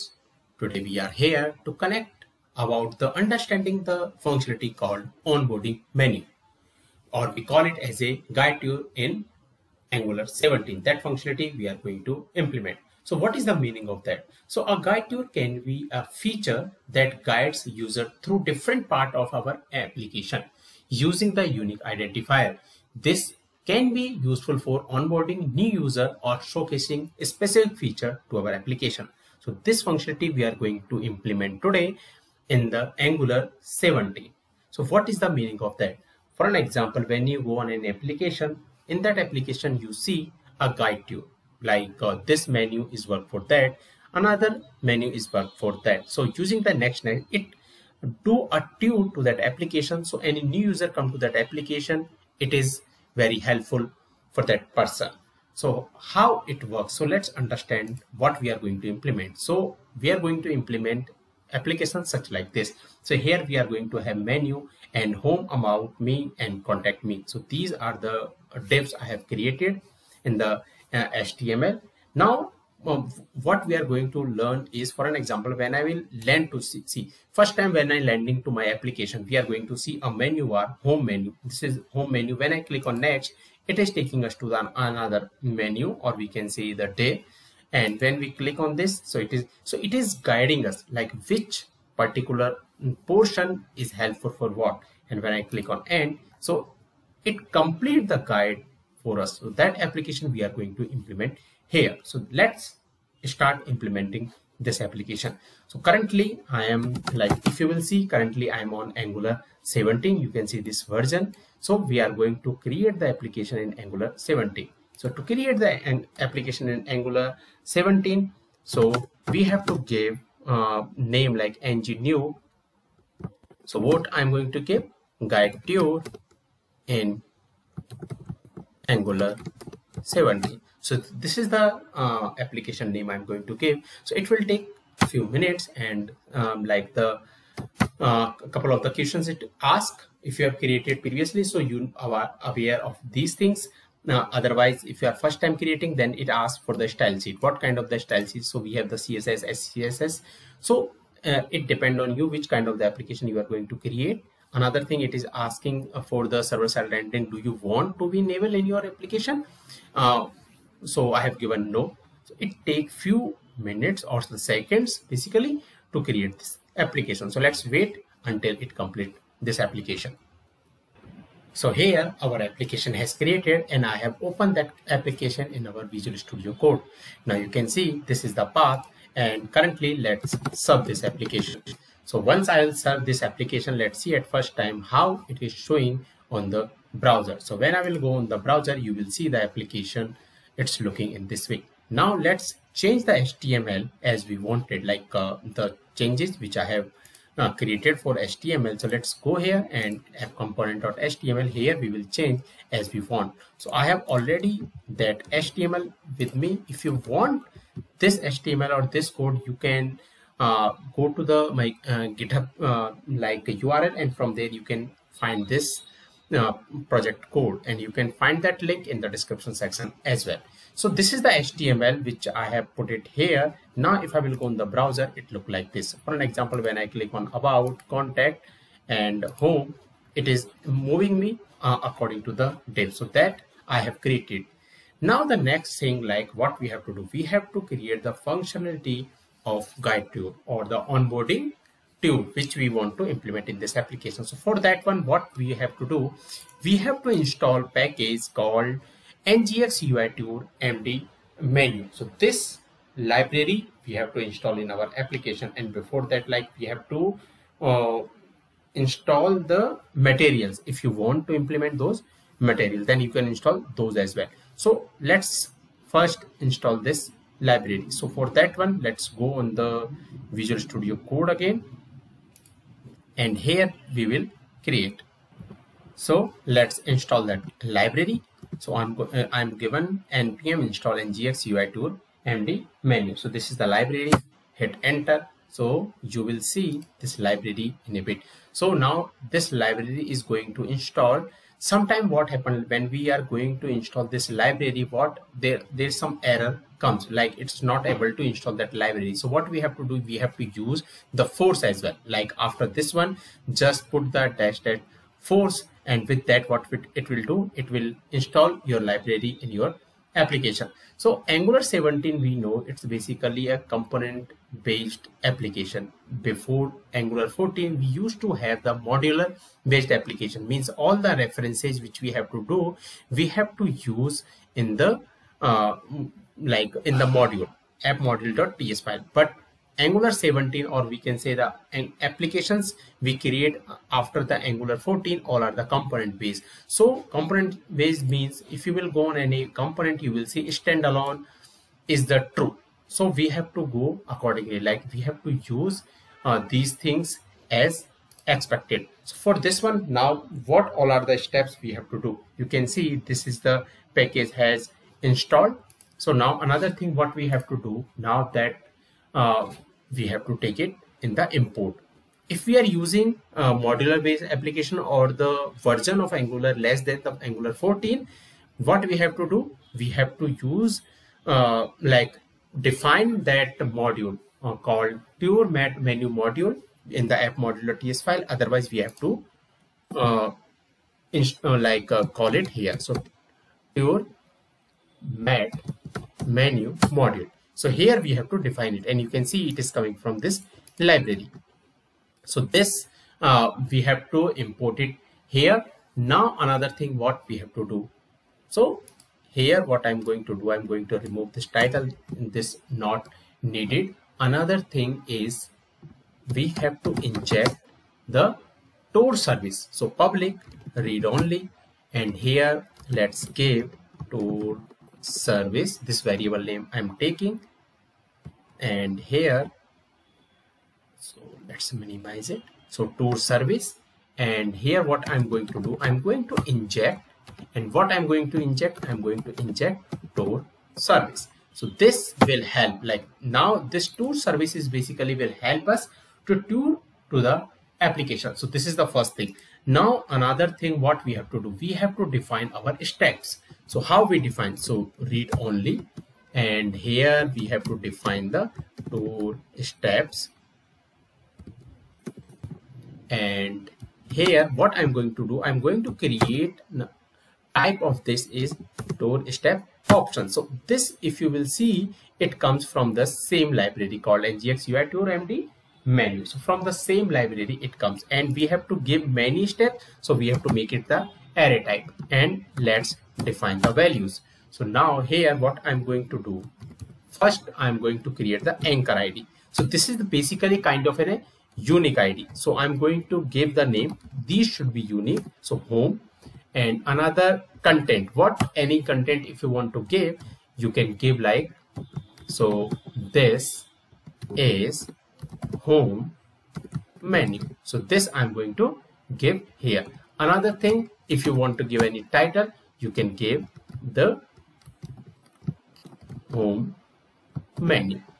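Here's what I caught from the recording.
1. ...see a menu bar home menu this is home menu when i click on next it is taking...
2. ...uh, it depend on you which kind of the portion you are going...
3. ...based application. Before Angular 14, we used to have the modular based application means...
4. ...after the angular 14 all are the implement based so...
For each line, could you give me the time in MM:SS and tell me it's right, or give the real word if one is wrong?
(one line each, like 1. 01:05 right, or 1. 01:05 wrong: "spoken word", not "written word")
1. 01:19 right
2. 02:31 wrong: "application", not "portion"
3. 05:14 right
4. 05:33 wrong: "component", not "implement".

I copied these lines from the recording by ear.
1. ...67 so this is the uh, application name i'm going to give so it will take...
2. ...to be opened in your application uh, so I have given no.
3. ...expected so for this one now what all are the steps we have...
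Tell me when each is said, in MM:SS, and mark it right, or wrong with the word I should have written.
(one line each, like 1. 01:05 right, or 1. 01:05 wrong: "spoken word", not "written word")
1. 02:10 wrong: "17", not "67"
2. 02:37 wrong: "enabled", not "opened"
3. 05:48 right.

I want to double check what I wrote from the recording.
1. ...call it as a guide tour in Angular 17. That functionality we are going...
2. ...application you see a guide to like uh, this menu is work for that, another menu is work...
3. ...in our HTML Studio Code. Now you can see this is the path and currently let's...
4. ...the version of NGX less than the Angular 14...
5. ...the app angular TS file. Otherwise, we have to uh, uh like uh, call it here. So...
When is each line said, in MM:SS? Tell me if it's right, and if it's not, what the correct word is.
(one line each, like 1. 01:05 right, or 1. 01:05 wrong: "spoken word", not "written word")
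1. 00:07 right
2. 00:39 right
3. 02:55 wrong: "Visual", not "HTML"
4. 06:05 wrong: "Angular", not "NGX"
5. 06:17 wrong: "modular", not "angular".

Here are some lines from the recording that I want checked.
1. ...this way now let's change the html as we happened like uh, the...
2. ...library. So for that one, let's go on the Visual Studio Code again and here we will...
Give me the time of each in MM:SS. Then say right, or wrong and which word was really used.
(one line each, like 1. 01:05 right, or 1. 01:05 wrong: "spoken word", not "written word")
1. 03:11 wrong: "wanted", not "happened"
2. 04:27 right.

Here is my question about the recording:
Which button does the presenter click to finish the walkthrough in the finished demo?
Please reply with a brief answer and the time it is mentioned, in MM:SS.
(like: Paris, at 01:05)
end, at 01:35.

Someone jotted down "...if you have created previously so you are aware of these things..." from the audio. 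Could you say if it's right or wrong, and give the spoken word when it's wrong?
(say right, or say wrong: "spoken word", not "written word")
right.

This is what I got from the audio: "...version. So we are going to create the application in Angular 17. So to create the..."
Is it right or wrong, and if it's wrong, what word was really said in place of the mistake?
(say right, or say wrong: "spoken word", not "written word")
right.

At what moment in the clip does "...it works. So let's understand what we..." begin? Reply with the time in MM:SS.
00:56.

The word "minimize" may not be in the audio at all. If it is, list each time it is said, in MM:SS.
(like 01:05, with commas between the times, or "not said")
07:01.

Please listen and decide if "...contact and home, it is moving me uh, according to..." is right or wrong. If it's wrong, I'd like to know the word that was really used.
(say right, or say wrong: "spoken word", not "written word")
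right.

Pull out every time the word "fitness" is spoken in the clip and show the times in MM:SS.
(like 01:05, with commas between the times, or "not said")
not said.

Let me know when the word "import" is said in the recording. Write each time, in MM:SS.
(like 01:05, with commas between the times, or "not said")
06:01, 06:34.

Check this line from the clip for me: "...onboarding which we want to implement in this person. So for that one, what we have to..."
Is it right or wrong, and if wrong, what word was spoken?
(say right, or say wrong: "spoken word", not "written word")
wrong: "application", not "person".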